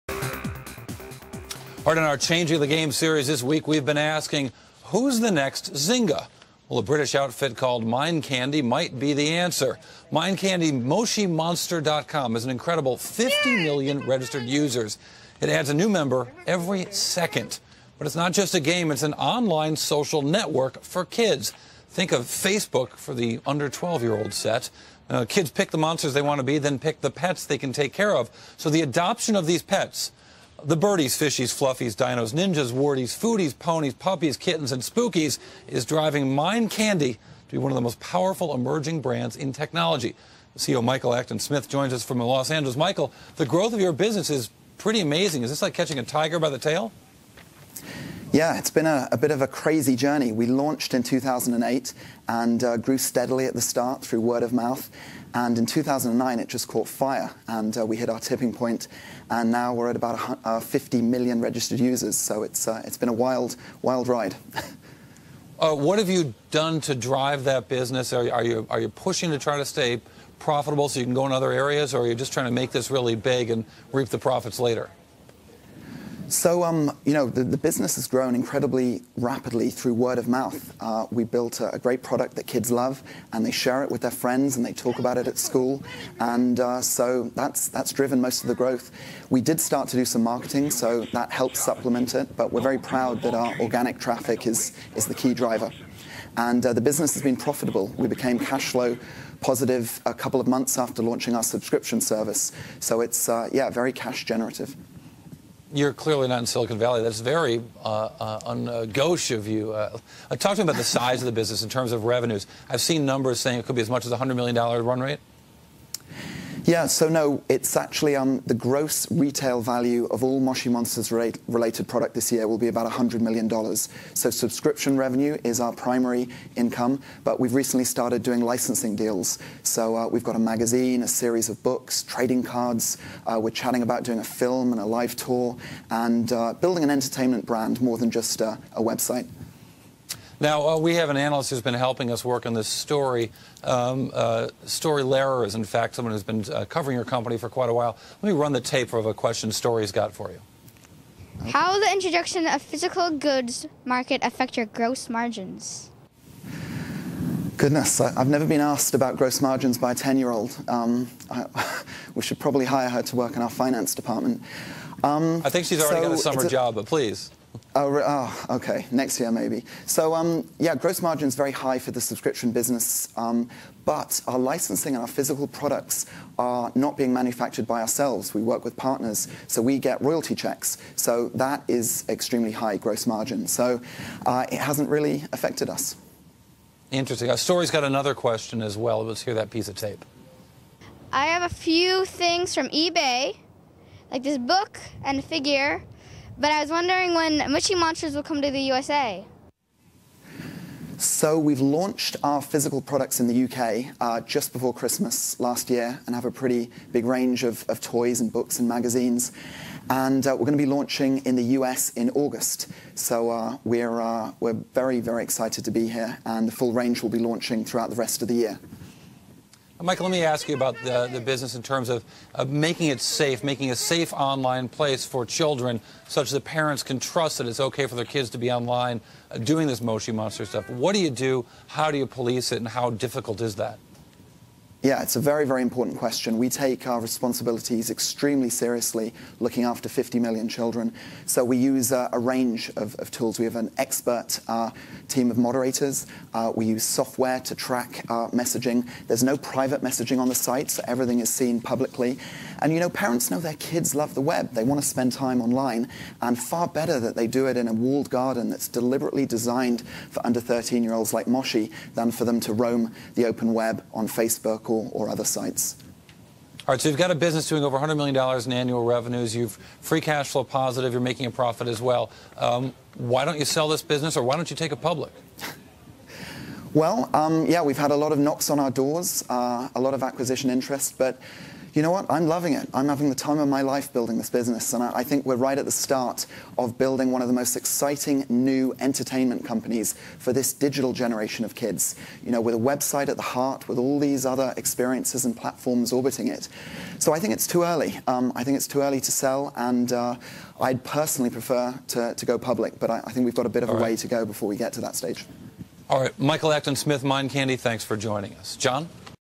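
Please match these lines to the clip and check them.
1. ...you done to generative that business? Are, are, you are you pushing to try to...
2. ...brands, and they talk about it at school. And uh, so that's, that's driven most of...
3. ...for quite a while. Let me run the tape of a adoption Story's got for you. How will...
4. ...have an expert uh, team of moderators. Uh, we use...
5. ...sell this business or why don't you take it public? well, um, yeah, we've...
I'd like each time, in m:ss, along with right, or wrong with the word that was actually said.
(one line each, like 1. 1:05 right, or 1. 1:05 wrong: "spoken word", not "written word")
1. 1:06 wrong: "drive", not "generative"
2. 1:24 wrong: "friends", not "brands"
3. 2:27 wrong: "question", not "adoption"
4. 4:03 right
5. 4:33 right.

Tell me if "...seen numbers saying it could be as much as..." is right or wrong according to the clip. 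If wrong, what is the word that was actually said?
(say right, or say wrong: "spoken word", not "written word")
right.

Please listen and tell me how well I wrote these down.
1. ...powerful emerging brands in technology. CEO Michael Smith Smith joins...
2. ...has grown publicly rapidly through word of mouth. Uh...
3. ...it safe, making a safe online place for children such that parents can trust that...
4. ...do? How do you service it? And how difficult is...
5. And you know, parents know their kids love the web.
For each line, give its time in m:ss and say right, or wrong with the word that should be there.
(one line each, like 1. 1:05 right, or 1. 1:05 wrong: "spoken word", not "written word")
1. 0:37 wrong: "Acton", not "Smith"
2. 1:17 wrong: "incredibly", not "publicly"
3. 3:42 right
4. 3:51 wrong: "police", not "service"
5. 4:12 right.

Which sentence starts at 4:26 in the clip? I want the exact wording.
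All right, so you've got a business doing over $100 million in annual revenues.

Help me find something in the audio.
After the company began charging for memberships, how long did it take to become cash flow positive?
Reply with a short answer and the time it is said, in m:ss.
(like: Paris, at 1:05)
a couple of months, at 1:40.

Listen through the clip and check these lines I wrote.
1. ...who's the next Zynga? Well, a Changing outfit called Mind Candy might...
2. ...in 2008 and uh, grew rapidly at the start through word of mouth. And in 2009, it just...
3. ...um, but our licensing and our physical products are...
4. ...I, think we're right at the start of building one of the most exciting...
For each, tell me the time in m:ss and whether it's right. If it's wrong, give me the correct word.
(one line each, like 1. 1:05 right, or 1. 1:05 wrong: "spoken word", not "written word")
1. 0:04 wrong: "British", not "Changing"
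2. 0:50 wrong: "steadily", not "rapidly"
3. 2:53 right
4. 4:44 right.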